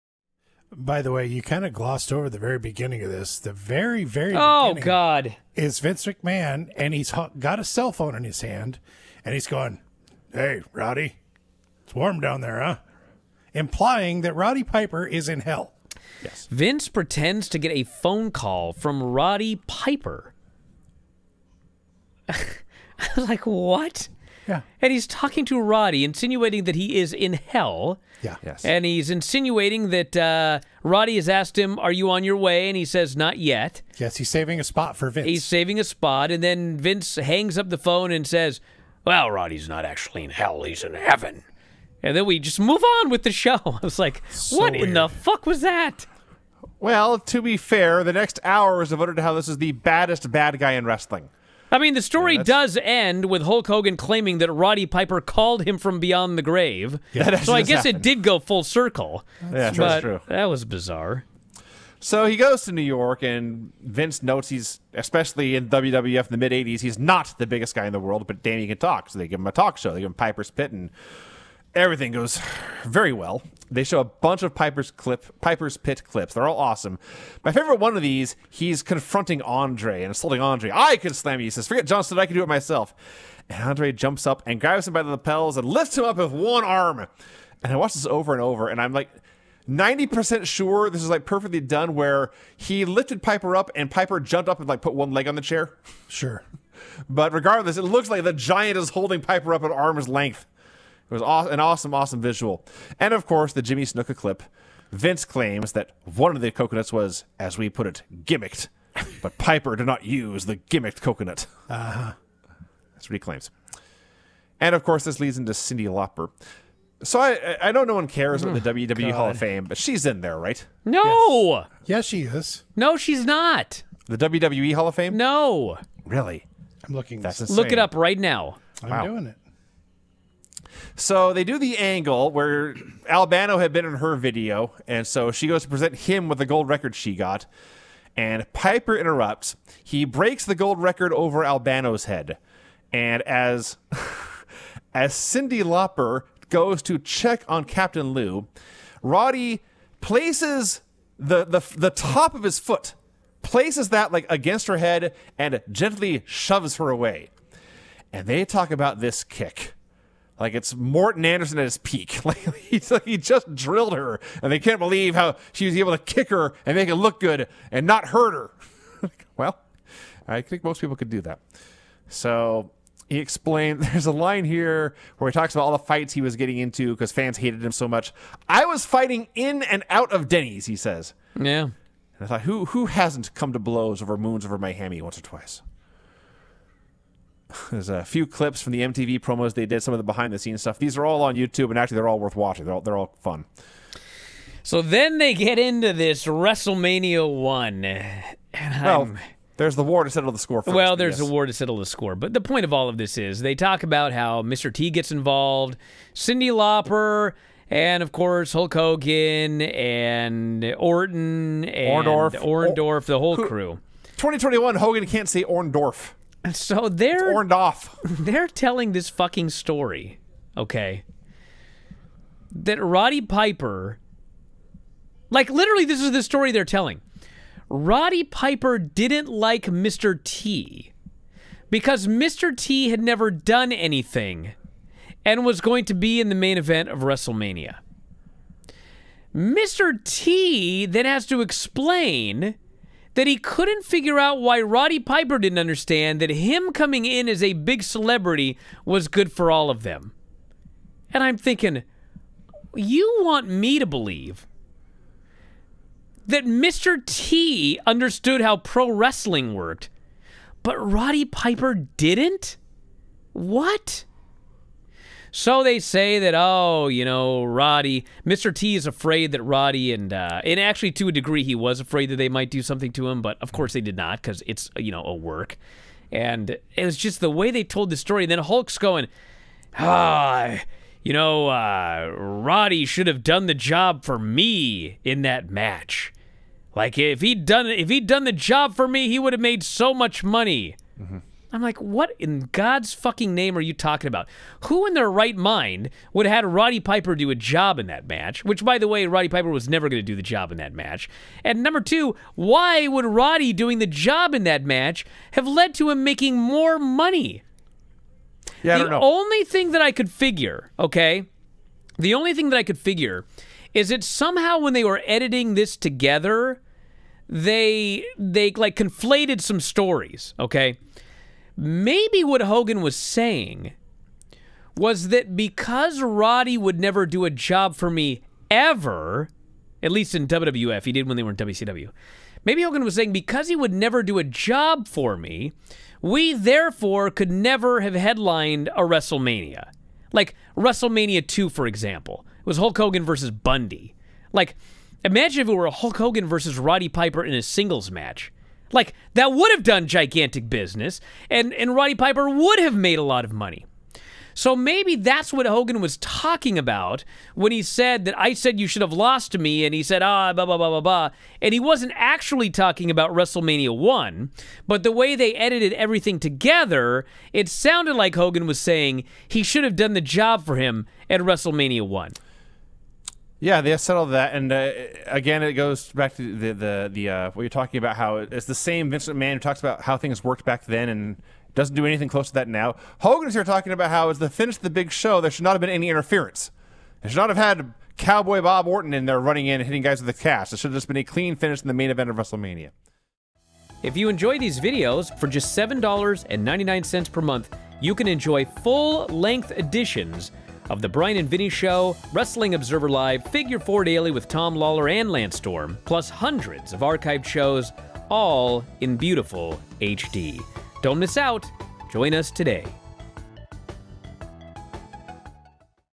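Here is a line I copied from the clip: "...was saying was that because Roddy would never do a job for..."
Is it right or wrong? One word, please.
right.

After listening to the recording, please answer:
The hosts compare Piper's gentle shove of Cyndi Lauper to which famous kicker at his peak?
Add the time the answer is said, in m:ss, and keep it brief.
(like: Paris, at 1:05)
Morten Andersen, at 2:40.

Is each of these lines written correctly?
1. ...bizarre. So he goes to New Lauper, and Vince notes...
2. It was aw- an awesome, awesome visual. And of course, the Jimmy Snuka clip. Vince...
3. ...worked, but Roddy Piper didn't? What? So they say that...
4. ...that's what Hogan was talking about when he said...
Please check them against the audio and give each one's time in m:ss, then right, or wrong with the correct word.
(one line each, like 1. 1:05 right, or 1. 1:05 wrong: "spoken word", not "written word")
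1. 1:00 wrong: "York", not "Lauper"
2. 1:41 right
3. 4:19 right
4. 5:54 right.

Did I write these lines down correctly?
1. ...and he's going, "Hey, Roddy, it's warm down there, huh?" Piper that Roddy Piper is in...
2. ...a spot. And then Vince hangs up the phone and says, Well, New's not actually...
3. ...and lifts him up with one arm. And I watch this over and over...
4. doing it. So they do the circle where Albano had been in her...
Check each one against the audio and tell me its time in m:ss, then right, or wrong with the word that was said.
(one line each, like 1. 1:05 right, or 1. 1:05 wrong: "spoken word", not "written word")
1. 0:09 wrong: "Implying", not "Piper"
2. 0:35 wrong: "Roddy", not "New"
3. 1:25 right
4. 2:09 wrong: "angle", not "circle".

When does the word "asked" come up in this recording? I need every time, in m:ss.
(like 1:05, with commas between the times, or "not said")
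0:31.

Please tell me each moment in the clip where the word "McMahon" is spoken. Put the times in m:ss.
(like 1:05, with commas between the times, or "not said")
0:06, 6:19.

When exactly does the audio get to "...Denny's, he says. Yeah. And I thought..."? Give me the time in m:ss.
3:00.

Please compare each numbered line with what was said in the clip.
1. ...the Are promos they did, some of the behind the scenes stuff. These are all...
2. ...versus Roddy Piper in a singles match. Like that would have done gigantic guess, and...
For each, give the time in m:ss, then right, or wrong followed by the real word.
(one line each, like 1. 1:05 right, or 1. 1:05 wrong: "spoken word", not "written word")
1. 3:08 wrong: "MTV", not "Are"
2. 5:46 wrong: "business", not "guess".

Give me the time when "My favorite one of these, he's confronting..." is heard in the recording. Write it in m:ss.
1:17.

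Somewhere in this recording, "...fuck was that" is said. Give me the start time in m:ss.
0:45.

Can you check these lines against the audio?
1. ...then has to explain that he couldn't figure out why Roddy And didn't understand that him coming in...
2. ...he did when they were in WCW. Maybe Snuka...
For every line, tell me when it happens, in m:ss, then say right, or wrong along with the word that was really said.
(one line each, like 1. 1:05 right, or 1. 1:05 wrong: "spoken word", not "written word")
1. 4:00 wrong: "Piper", not "And"
2. 5:30 wrong: "Hogan", not "Snuka".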